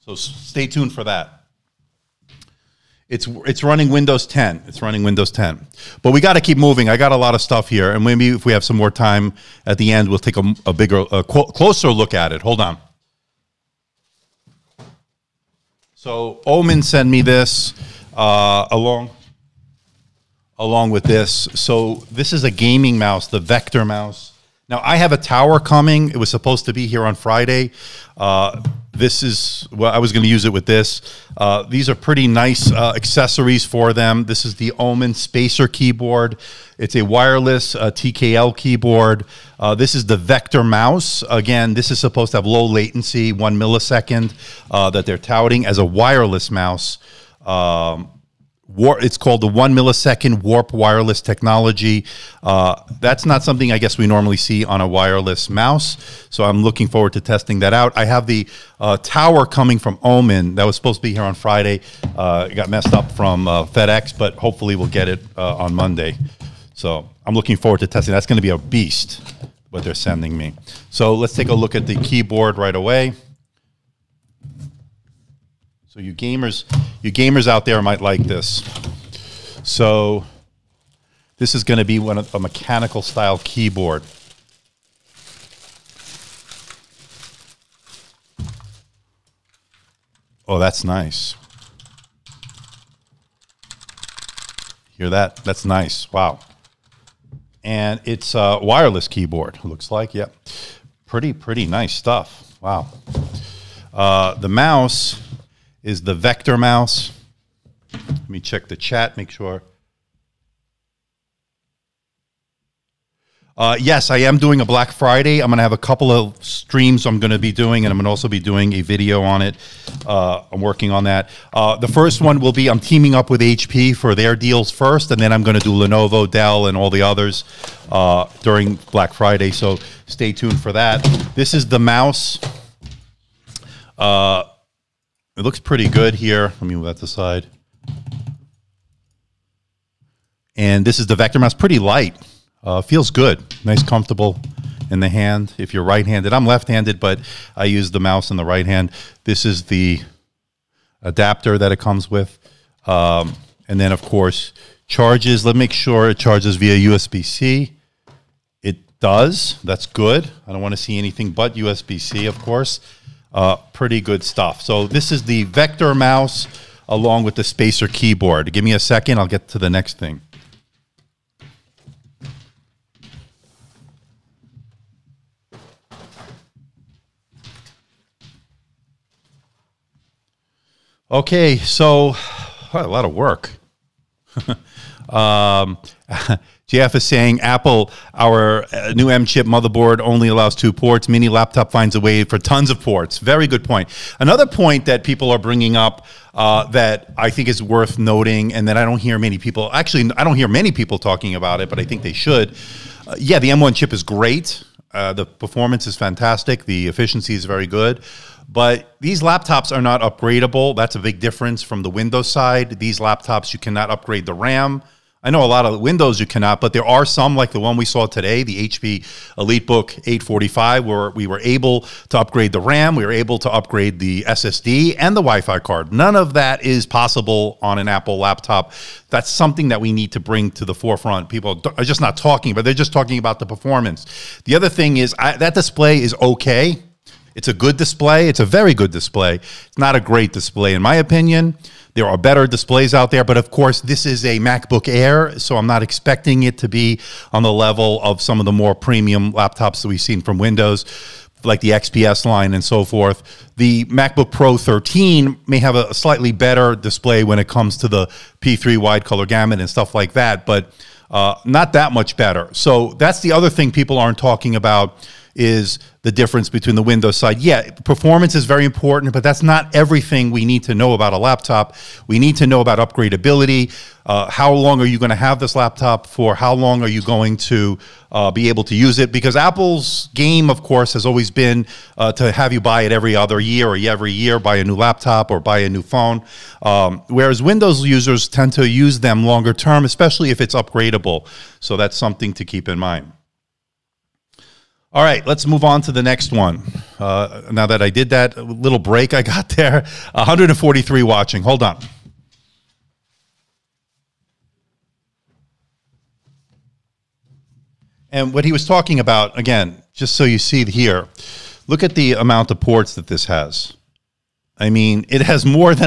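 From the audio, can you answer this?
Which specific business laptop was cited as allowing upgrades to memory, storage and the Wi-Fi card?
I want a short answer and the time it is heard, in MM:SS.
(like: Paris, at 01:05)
HP EliteBook 845, at 03:38.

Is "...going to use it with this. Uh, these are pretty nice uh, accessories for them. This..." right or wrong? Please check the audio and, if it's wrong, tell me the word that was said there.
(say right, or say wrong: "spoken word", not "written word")
right.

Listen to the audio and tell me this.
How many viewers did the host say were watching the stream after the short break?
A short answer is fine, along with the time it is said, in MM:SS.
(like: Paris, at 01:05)
143, at 05:00.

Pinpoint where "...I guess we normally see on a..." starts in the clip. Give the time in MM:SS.
00:53.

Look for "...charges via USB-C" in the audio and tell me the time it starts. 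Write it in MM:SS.
02:36.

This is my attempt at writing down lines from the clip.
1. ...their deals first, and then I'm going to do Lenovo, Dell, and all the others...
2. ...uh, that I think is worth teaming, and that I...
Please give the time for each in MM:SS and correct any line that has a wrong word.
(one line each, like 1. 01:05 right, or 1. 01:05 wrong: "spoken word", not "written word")
1. 02:04 right
2. 03:16 wrong: "noting", not "teaming".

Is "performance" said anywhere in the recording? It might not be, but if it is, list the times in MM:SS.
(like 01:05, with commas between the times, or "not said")
03:25, 03:53, 04:27.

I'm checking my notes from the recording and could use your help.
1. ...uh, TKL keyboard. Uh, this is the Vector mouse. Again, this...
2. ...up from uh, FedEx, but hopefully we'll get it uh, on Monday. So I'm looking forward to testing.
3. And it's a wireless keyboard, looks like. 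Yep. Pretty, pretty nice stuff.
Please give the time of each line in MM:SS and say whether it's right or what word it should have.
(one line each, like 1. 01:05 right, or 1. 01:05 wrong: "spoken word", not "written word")
1. 00:37 right
2. 01:02 right
3. 01:37 right.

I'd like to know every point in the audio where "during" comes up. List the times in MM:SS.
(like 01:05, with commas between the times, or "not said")
02:08.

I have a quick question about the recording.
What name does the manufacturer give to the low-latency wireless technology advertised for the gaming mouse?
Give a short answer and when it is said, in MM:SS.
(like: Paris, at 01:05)
Warp wireless technology, at 00:50.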